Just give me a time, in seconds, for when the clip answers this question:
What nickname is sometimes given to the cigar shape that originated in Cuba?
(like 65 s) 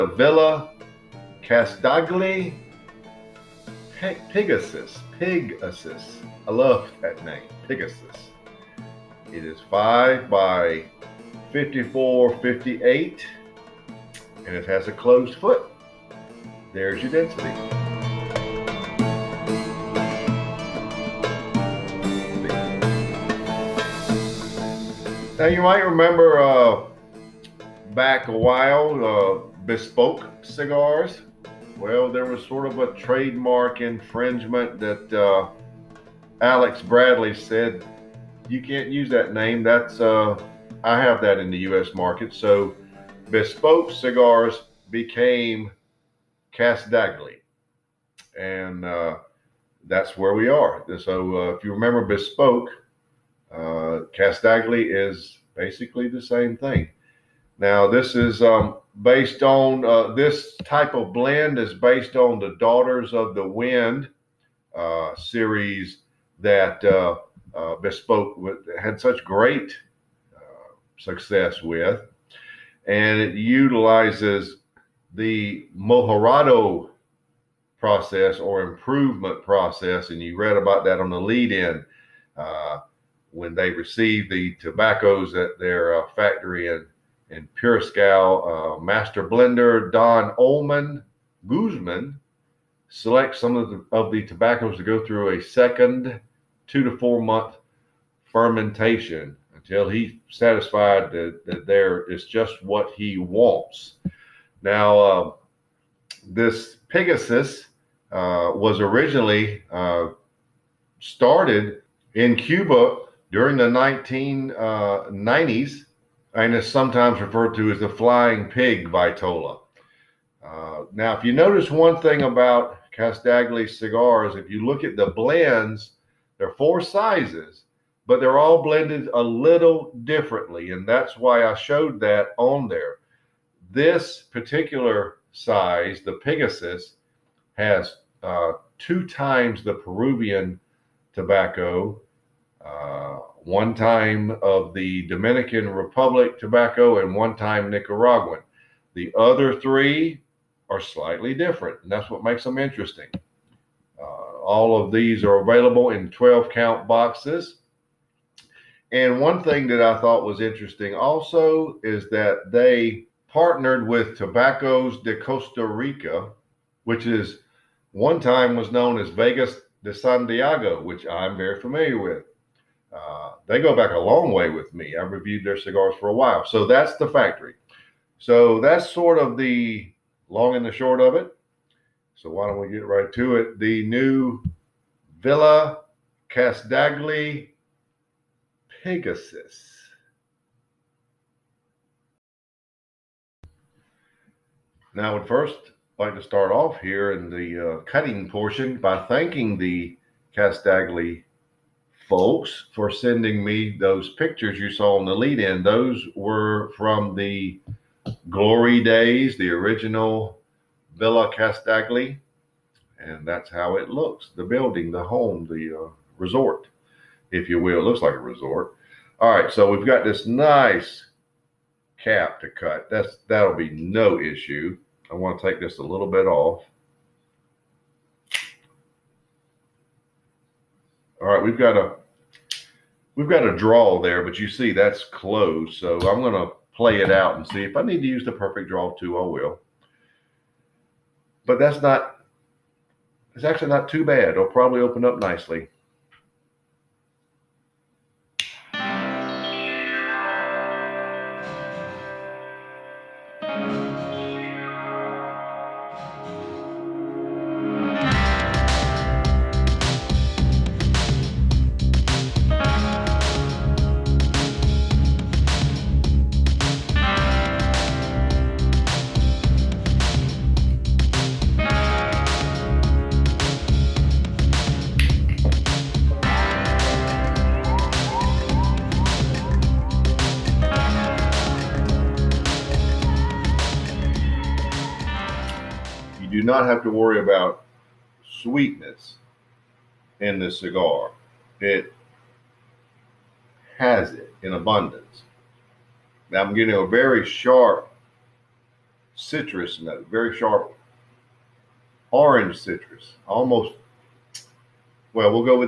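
117 s.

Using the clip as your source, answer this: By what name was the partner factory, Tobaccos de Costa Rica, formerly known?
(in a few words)
Vegas de Santiago.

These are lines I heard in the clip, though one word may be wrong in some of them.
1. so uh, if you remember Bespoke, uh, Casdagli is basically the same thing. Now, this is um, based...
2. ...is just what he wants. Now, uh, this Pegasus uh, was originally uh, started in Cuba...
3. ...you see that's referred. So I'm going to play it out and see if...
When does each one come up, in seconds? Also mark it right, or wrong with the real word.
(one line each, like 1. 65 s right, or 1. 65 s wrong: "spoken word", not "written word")
1. 50 s right
2. 102 s right
3. 234 s wrong: "closed", not "referred".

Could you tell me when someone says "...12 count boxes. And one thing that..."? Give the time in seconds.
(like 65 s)
156 s.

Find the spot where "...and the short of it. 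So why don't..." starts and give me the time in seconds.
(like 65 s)
180 s.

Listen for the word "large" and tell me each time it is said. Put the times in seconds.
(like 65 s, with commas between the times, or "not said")
not said.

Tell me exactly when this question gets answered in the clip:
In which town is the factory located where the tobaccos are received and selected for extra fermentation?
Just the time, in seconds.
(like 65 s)
87 s.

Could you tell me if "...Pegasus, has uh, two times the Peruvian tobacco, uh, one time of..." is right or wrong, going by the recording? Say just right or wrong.
right.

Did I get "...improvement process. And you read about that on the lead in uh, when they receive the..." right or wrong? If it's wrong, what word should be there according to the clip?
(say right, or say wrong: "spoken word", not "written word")
right.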